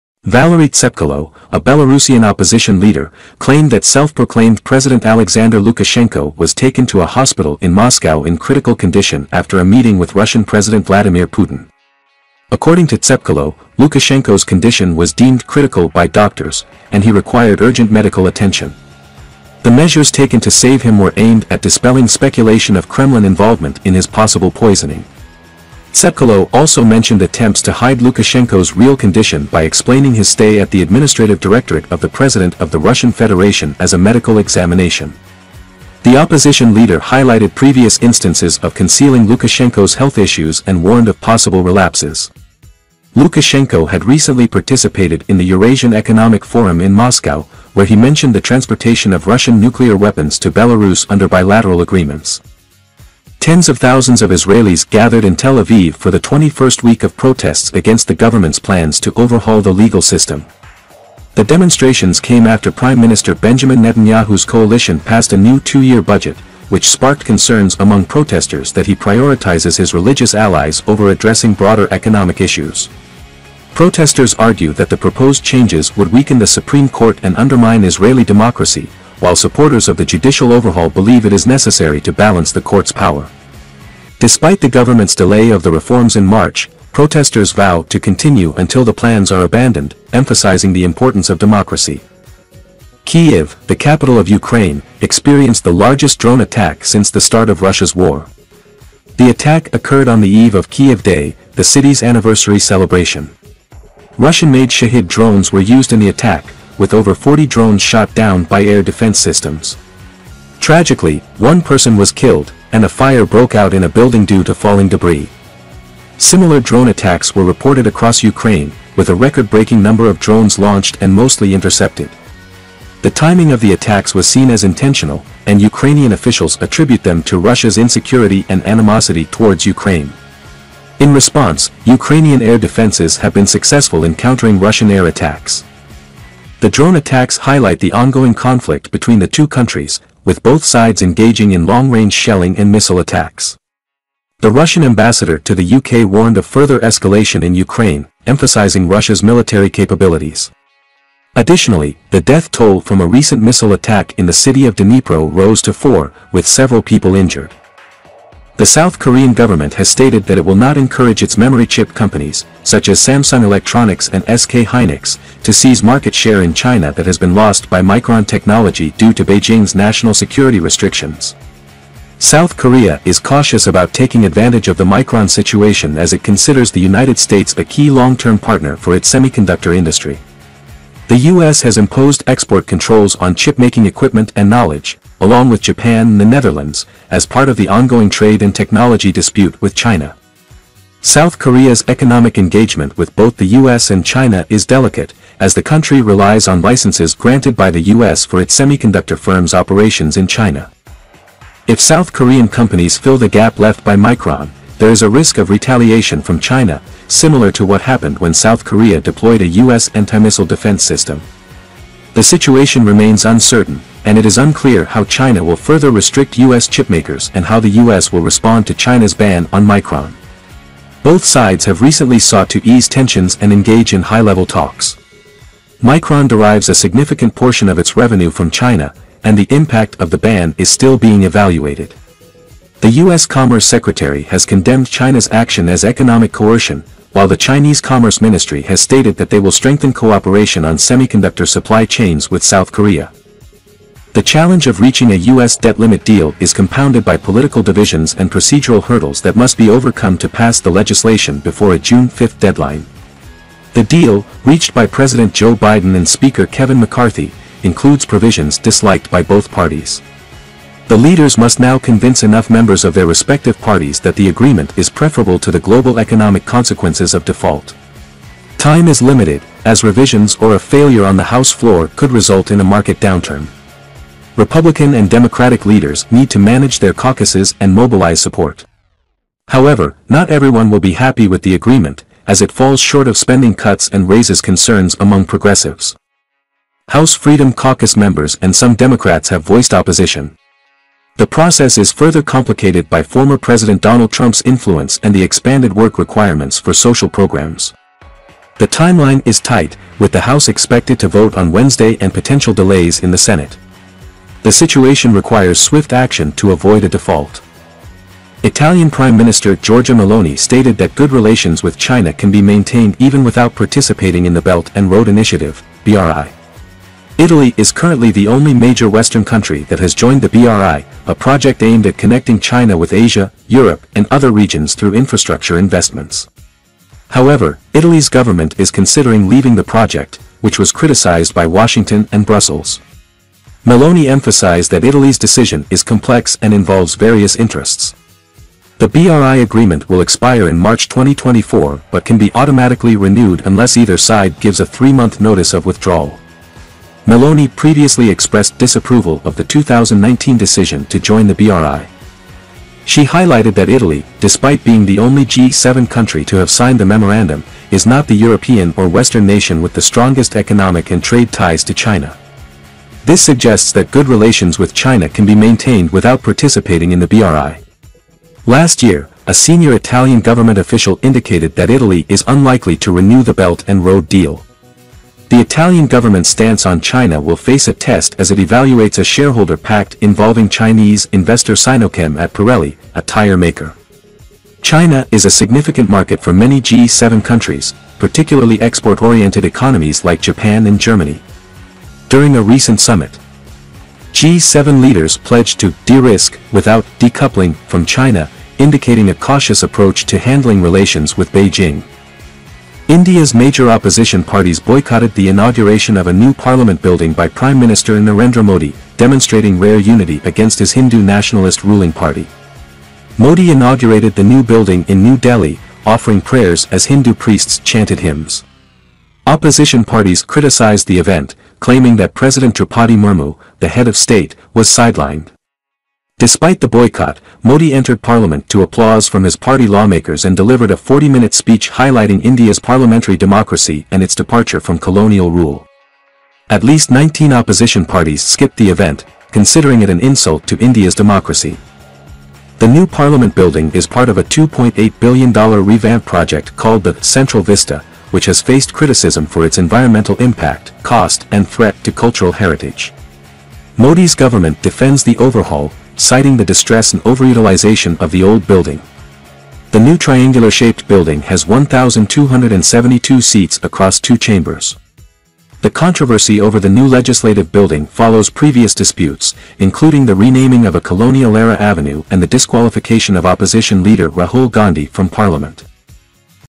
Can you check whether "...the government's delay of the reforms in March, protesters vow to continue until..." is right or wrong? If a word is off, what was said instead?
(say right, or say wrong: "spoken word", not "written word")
right.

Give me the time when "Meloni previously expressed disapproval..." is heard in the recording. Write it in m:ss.
5:47.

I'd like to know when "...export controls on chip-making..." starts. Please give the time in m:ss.
3:02.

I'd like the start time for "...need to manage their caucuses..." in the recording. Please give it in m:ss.
4:36.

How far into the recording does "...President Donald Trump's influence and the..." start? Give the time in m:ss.
4:53.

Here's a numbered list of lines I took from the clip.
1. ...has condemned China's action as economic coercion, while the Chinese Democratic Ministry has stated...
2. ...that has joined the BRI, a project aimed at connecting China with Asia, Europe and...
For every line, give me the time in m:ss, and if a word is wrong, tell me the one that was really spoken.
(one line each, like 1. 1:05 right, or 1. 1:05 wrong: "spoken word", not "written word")
1. 3:54 wrong: "Commerce", not "Democratic"
2. 5:19 right.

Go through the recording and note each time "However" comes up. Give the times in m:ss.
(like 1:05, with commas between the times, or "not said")
4:39, 5:27.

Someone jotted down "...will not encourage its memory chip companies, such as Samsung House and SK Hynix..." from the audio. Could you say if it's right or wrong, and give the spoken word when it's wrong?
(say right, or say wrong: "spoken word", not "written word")
wrong: "Electronics", not "House".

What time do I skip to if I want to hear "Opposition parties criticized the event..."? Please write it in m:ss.
6:59.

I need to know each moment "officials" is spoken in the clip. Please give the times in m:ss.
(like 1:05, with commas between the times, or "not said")
2:06, 6:10.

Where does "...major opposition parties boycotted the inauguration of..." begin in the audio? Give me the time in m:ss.
6:43.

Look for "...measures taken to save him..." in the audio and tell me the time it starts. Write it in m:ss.
0:19.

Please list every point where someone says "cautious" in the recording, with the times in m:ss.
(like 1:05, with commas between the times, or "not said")
2:53, 6:39.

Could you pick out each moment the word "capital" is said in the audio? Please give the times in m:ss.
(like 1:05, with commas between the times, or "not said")
1:33.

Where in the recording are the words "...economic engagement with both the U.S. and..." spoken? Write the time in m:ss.
3:11.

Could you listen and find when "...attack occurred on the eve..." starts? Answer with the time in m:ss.
1:39.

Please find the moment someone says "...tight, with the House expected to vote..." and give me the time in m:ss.
4:59.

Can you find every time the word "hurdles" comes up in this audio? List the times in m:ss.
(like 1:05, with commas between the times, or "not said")
4:08.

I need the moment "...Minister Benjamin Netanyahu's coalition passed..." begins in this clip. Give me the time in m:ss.
1:03.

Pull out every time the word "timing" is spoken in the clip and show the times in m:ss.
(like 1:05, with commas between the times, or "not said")
2:03.